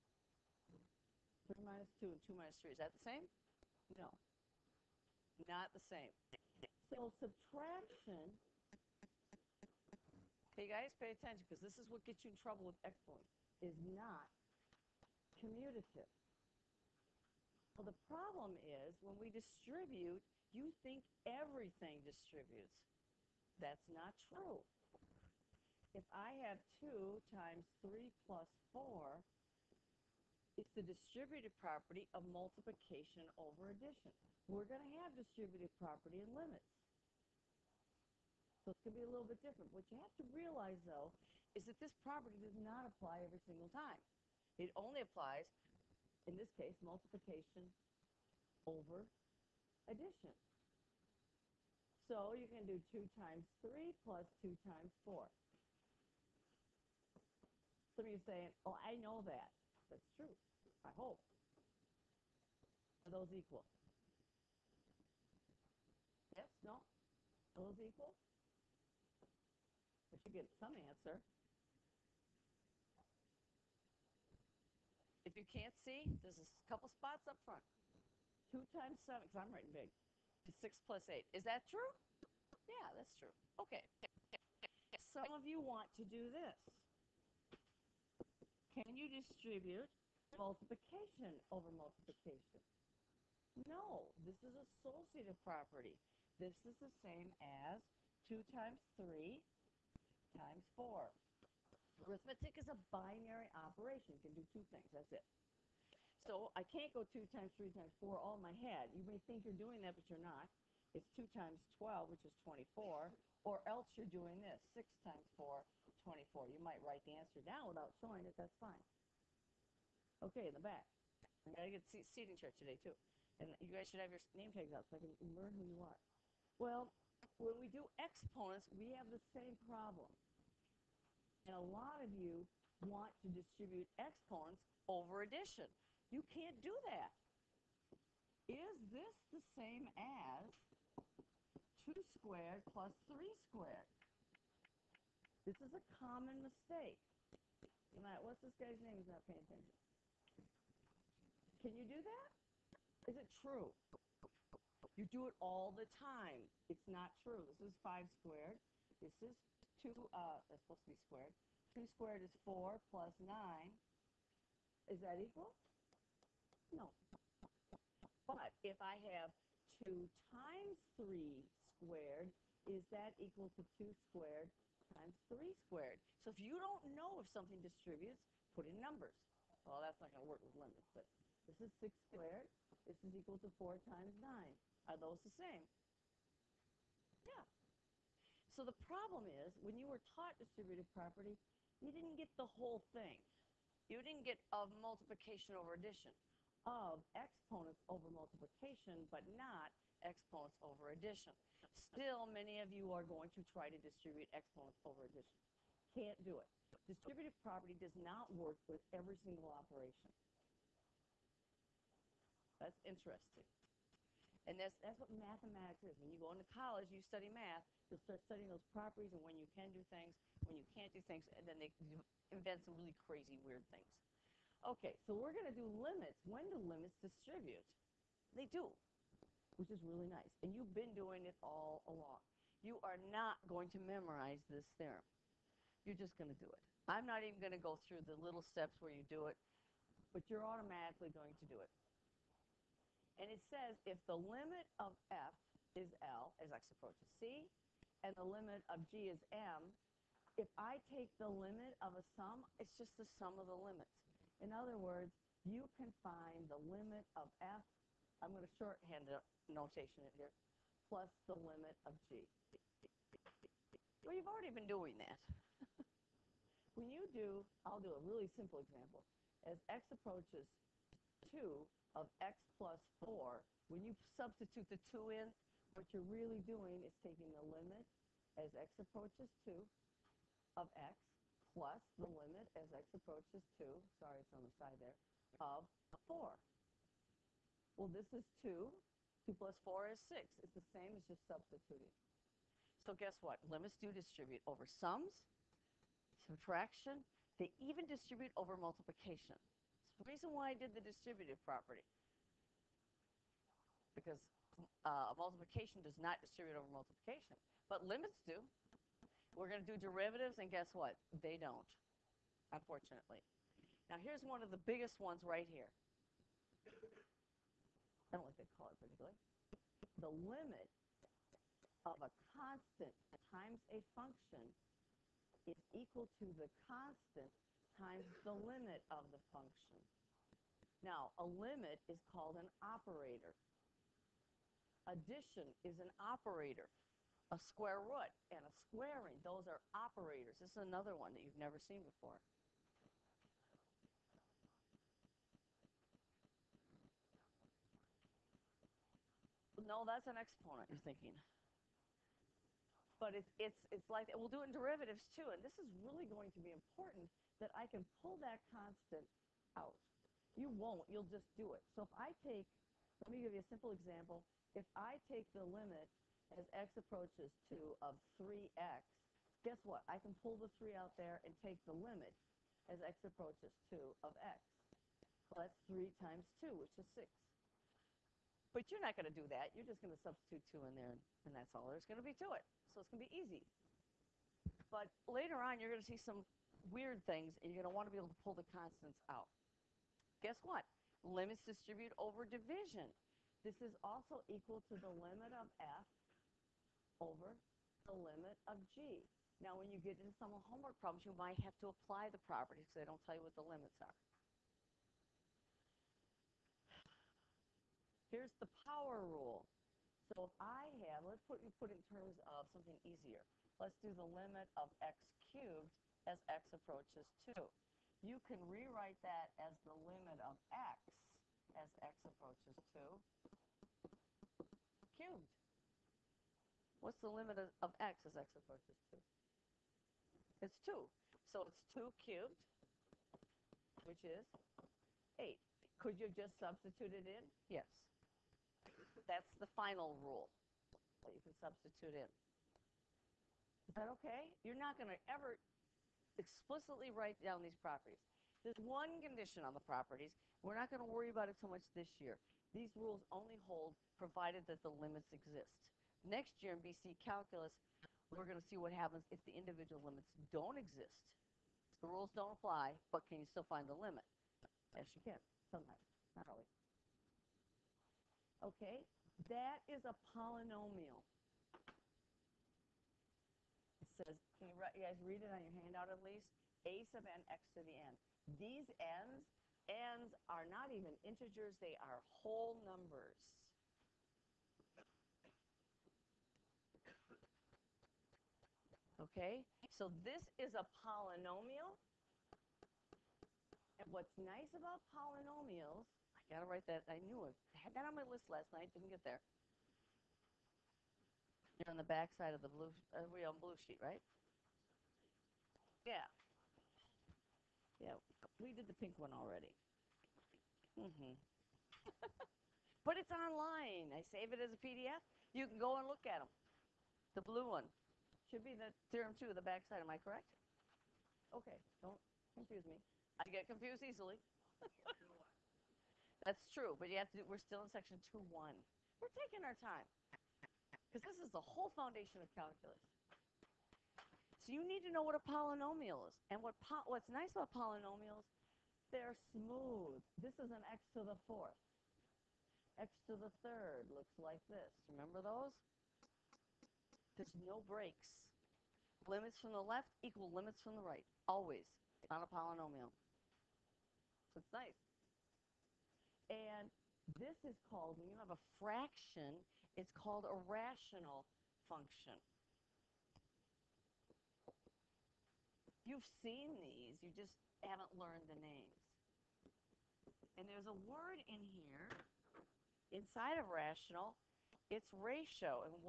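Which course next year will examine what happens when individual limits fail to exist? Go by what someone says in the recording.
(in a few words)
BC calculus.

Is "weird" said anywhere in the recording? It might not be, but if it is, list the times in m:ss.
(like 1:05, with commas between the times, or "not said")
3:43, 6:26.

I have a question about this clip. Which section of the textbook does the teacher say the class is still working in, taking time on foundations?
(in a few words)
section 2-1.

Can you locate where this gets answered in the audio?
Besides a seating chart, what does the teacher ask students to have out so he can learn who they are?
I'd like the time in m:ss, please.
2:04.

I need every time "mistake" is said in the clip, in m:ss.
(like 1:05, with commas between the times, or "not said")
2:26.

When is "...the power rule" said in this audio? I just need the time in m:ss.
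6:48.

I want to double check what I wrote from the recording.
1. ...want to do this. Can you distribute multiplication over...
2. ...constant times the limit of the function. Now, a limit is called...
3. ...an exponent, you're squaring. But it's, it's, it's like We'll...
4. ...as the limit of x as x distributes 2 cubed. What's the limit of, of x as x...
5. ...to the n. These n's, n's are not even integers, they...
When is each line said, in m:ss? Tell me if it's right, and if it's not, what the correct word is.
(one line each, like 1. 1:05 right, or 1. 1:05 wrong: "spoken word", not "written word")
1. 1:25 right
2. 5:26 right
3. 5:50 wrong: "thinking", not "squaring"
4. 6:59 wrong: "approaches", not "distributes"
5. 7:57 right.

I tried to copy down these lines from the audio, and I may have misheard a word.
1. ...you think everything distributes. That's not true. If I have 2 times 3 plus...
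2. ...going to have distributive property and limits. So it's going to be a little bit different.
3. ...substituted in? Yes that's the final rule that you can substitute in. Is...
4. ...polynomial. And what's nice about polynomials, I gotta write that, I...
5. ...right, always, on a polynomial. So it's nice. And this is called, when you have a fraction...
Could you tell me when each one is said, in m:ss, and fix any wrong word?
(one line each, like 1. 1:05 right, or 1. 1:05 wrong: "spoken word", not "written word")
1. 0:20 right
2. 0:34 right
3. 7:16 right
4. 8:10 right
5. 9:10 right.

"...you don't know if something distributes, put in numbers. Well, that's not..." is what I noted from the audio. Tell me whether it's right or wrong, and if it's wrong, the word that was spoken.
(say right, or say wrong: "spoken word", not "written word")
right.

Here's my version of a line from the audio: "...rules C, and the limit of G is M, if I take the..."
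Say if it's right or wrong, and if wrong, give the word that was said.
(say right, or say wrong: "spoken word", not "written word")
wrong: "approaches", not "rules".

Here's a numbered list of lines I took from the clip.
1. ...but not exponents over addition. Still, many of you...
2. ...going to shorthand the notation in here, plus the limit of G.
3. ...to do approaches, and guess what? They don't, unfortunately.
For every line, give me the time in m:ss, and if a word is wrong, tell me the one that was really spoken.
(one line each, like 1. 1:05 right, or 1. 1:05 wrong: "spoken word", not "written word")
1. 3:19 right
2. 4:18 right
3. 5:09 wrong: "derivatives", not "approaches".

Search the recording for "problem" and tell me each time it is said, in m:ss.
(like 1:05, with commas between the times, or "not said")
0:18, 2:09, 3:08, 6:40.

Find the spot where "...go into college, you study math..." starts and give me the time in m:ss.
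3:36.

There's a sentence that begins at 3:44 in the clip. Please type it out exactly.
Okay, so we're going to do limits.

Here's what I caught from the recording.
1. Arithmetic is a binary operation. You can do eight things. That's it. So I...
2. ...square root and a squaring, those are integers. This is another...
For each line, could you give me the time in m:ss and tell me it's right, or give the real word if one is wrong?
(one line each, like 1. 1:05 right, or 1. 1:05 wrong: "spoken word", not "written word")
1. 1:42 wrong: "two", not "eight"
2. 5:37 wrong: "operators", not "integers".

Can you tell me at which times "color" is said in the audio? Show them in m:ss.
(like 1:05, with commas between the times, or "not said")
5:18.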